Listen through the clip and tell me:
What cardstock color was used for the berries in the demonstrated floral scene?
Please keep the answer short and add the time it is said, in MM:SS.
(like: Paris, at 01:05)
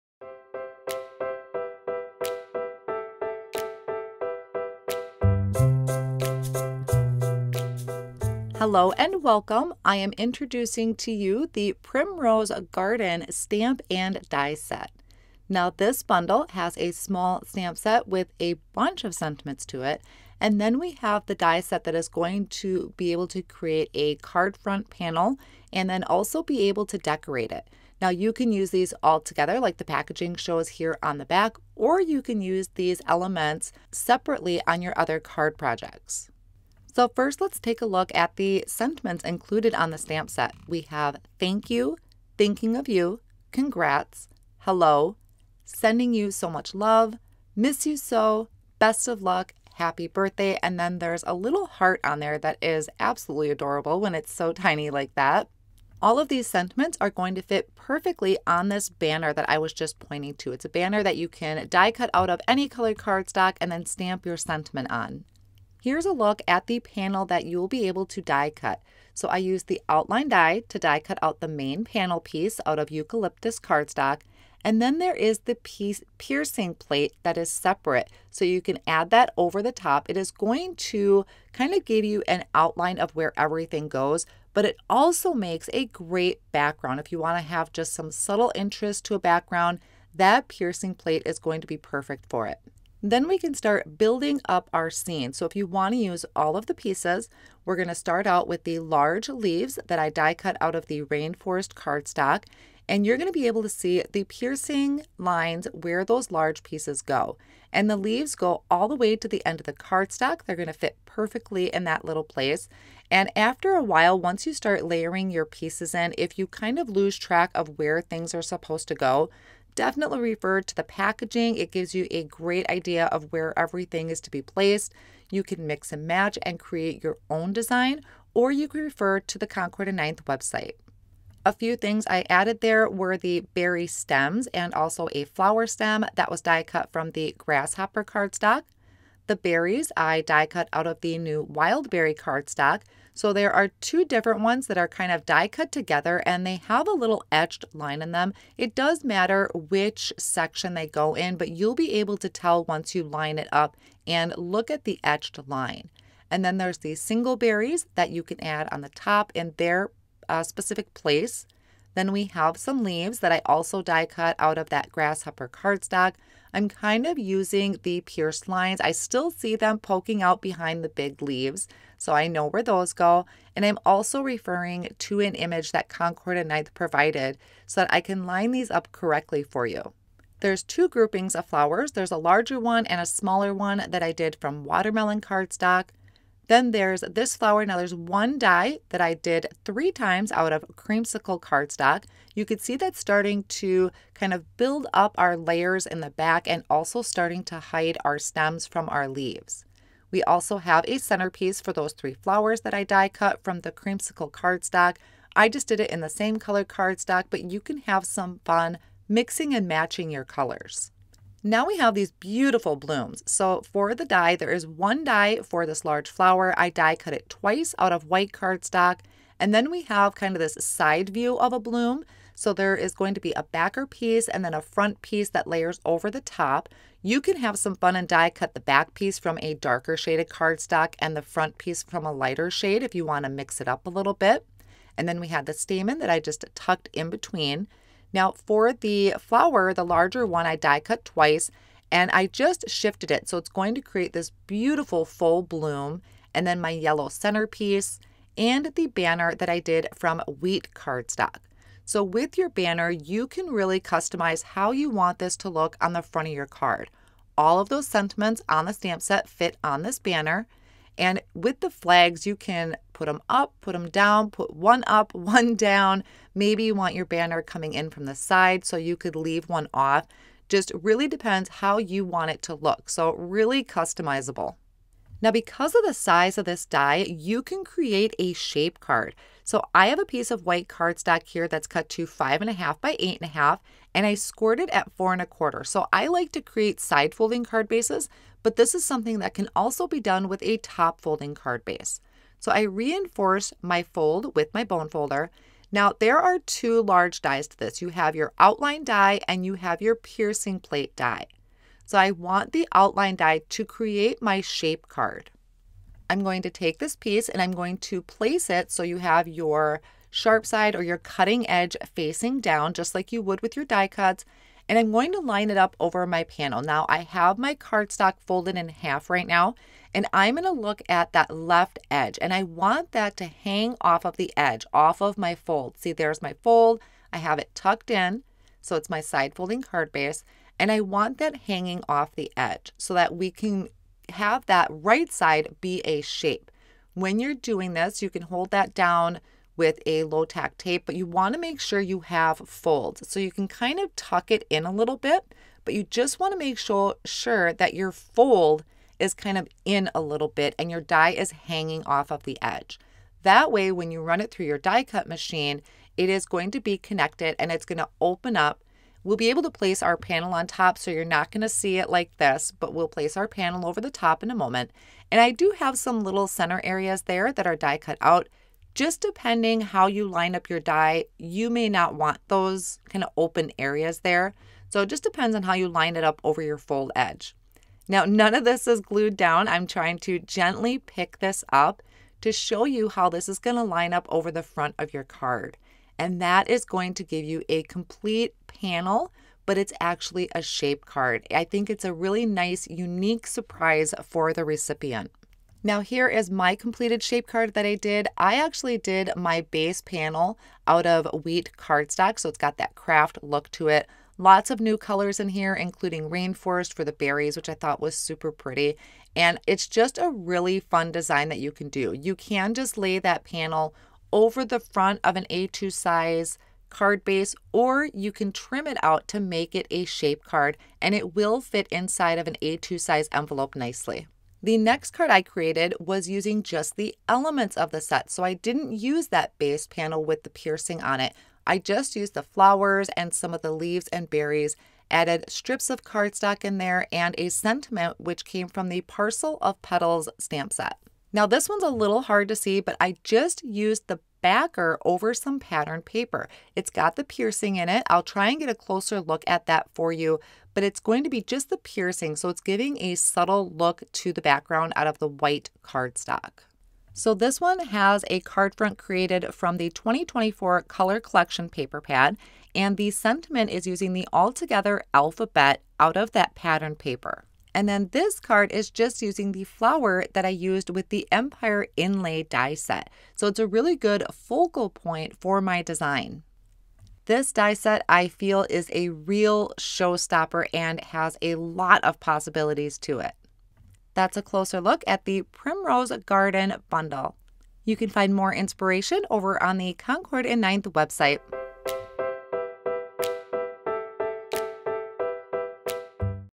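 Wild berry, at 02:21.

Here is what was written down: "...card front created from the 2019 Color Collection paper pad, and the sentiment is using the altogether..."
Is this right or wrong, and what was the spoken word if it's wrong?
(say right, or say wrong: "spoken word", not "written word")
wrong: "2024", not "2019".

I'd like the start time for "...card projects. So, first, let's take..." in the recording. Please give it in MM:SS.
00:35.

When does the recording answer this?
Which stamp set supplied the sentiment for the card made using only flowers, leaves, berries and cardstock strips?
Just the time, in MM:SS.
07:18.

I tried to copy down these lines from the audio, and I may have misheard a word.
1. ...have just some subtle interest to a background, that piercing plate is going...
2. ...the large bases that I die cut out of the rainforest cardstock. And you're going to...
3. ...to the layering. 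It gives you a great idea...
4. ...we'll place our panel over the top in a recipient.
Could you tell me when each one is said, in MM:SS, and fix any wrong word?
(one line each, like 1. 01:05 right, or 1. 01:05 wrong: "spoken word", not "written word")
1. 01:27 right
2. 01:38 wrong: "leaves", not "bases"
3. 02:00 wrong: "packaging", not "layering"
4. 06:02 wrong: "moment", not "recipient".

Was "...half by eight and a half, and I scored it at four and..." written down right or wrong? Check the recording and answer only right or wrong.
right.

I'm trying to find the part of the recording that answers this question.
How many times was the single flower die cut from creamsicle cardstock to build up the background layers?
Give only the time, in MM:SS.
03:09.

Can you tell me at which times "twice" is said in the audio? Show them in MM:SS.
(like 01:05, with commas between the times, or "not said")
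03:37, 04:01.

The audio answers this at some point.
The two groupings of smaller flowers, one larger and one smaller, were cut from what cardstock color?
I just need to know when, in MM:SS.
03:04.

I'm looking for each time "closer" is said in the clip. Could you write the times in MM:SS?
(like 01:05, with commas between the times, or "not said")
07:28, 08:04.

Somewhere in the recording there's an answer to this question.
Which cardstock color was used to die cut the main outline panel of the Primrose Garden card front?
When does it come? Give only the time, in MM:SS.
01:12.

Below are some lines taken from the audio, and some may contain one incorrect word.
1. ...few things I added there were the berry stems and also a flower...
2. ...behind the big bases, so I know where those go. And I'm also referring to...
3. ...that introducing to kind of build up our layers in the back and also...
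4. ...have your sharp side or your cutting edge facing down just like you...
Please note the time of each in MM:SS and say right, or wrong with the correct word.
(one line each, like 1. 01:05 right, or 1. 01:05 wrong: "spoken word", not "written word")
1. 02:11 right
2. 02:50 wrong: "leaves", not "bases"
3. 03:12 wrong: "starting", not "introducing"
4. 05:08 right.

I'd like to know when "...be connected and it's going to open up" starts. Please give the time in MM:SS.
05:56.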